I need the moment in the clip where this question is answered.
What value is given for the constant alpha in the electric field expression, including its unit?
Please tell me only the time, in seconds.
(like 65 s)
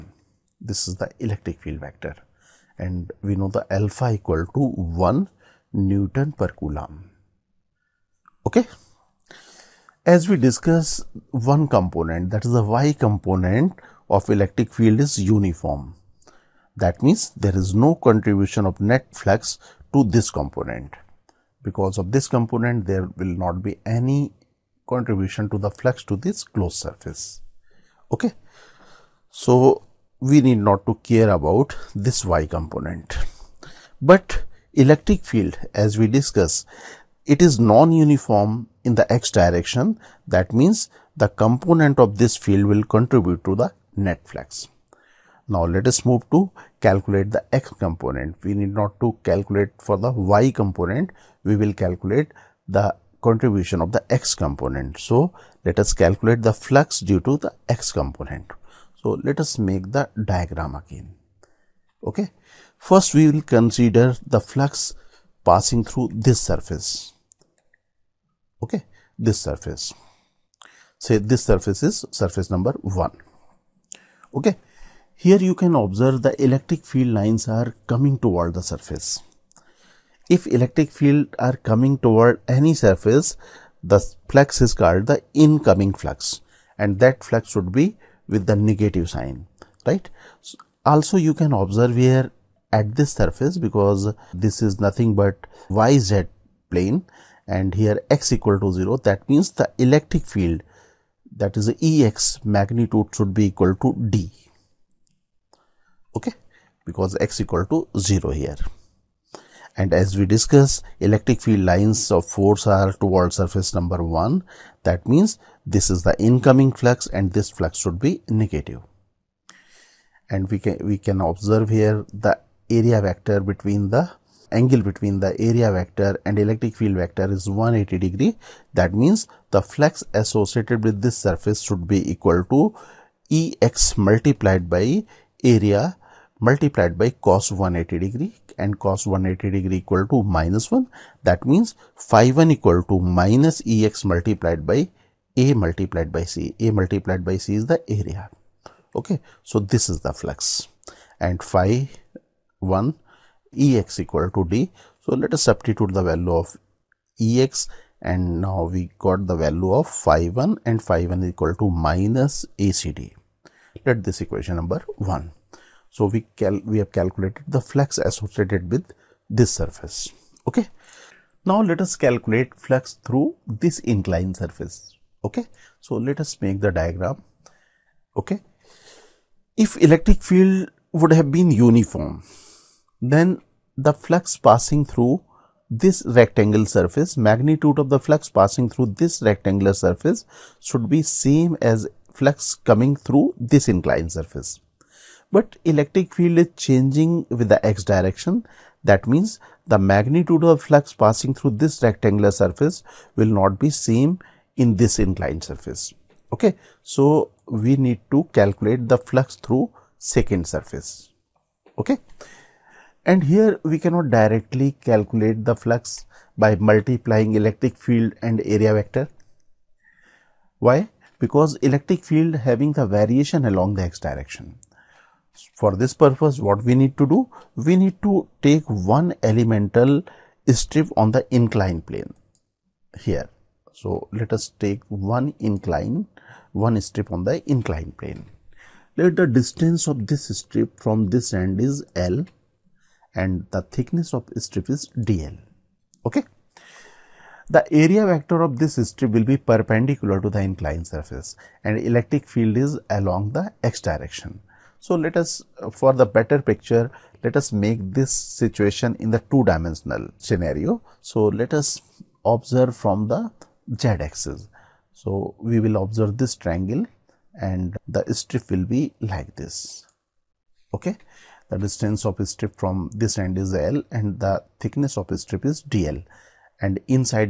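5 s.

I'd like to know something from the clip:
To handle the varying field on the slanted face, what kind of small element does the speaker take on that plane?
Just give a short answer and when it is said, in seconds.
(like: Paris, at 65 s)
elemental strip, at 229 s.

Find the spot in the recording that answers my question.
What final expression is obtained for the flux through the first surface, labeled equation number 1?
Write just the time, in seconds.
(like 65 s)
161 s.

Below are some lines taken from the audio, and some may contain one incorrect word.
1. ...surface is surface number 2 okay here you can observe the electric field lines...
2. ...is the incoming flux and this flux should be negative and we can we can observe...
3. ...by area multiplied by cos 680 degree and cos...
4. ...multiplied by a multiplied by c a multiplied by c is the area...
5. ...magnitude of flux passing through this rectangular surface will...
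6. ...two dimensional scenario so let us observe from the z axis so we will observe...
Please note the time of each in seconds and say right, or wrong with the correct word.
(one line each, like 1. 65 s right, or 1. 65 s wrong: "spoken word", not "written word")
1. 71 s wrong: "1", not "2"
2. 115 s right
3. 134 s wrong: "180", not "680"
4. 144 s right
5. 199 s right
6. 259 s right.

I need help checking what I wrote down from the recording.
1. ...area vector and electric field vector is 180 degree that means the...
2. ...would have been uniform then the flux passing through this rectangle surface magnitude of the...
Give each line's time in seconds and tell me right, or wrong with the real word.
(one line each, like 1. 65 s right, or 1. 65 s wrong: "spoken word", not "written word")
1. 125 s right
2. 180 s right.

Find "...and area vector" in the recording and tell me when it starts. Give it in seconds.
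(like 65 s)
218 s.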